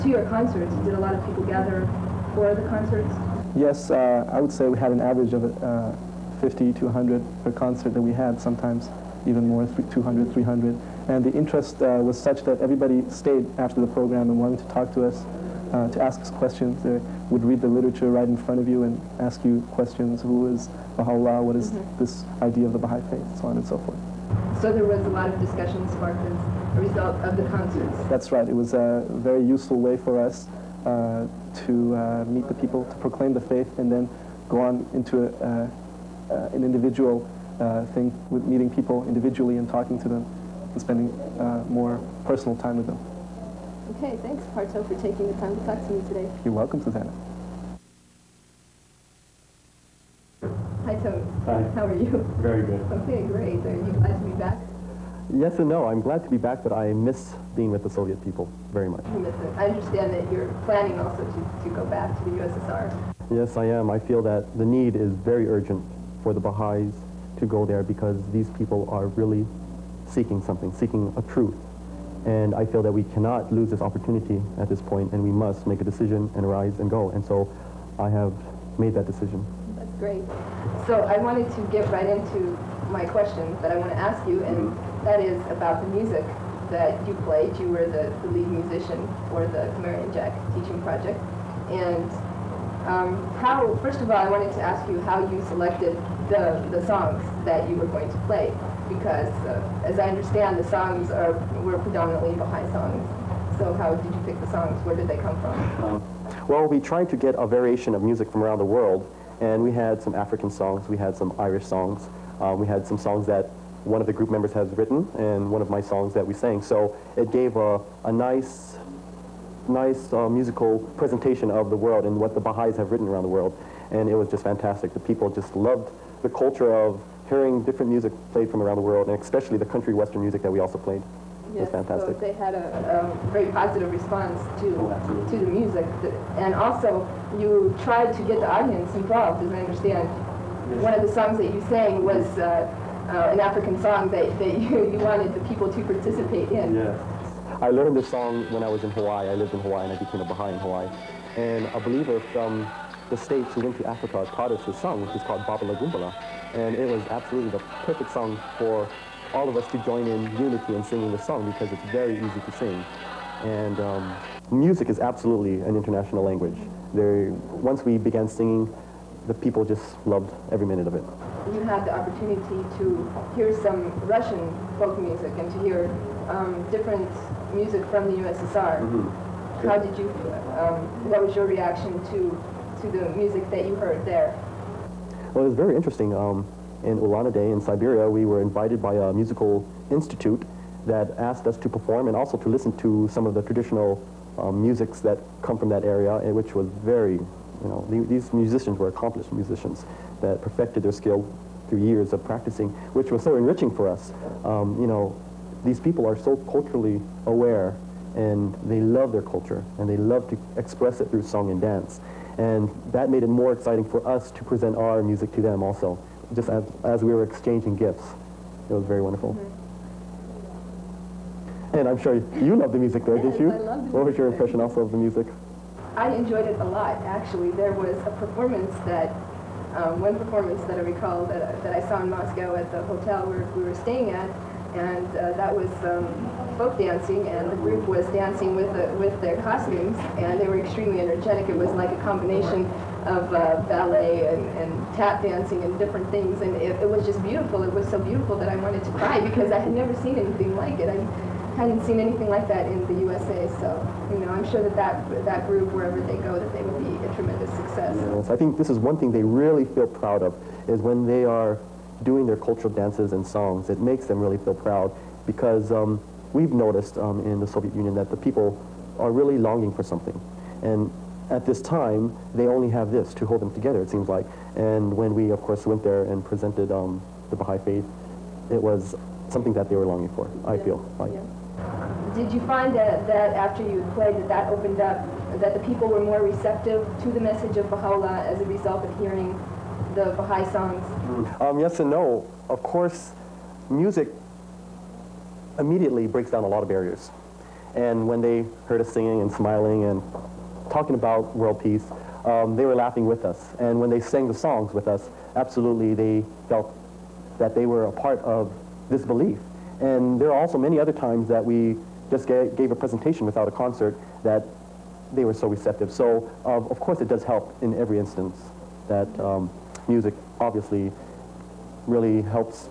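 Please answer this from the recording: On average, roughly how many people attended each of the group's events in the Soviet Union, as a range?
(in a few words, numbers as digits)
50 to 100.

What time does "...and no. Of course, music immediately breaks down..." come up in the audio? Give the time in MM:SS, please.
04:51.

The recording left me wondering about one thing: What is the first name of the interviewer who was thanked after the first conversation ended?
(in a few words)
Susanna.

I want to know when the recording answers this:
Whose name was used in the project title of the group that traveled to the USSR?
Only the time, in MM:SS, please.
01:29.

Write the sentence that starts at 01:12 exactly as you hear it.
And I feel that we cannot lose this opportunity at this point, and we must make a decision and arise and go.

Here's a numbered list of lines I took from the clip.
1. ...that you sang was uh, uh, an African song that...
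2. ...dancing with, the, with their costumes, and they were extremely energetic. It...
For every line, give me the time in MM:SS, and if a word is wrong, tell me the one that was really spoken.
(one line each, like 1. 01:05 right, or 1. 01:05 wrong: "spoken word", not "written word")
1. 02:21 right
2. 03:58 right.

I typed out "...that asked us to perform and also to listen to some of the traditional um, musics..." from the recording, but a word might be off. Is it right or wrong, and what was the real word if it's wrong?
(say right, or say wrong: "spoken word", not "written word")
right.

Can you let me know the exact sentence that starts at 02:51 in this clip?
You had the opportunity to hear some Russian folk music and to hear um, different music from the USSR.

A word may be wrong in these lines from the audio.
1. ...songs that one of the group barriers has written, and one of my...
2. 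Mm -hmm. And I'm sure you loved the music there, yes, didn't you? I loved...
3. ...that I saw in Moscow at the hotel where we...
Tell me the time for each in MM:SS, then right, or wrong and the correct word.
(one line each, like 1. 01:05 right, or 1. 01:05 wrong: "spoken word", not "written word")
1. 01:52 wrong: "members", not "barriers"
2. 03:39 right
3. 03:51 right.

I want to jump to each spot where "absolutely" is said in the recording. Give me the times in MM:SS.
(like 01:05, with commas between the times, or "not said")
02:37, 02:44, 05:05.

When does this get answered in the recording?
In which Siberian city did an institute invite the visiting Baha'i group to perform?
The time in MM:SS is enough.
03:06.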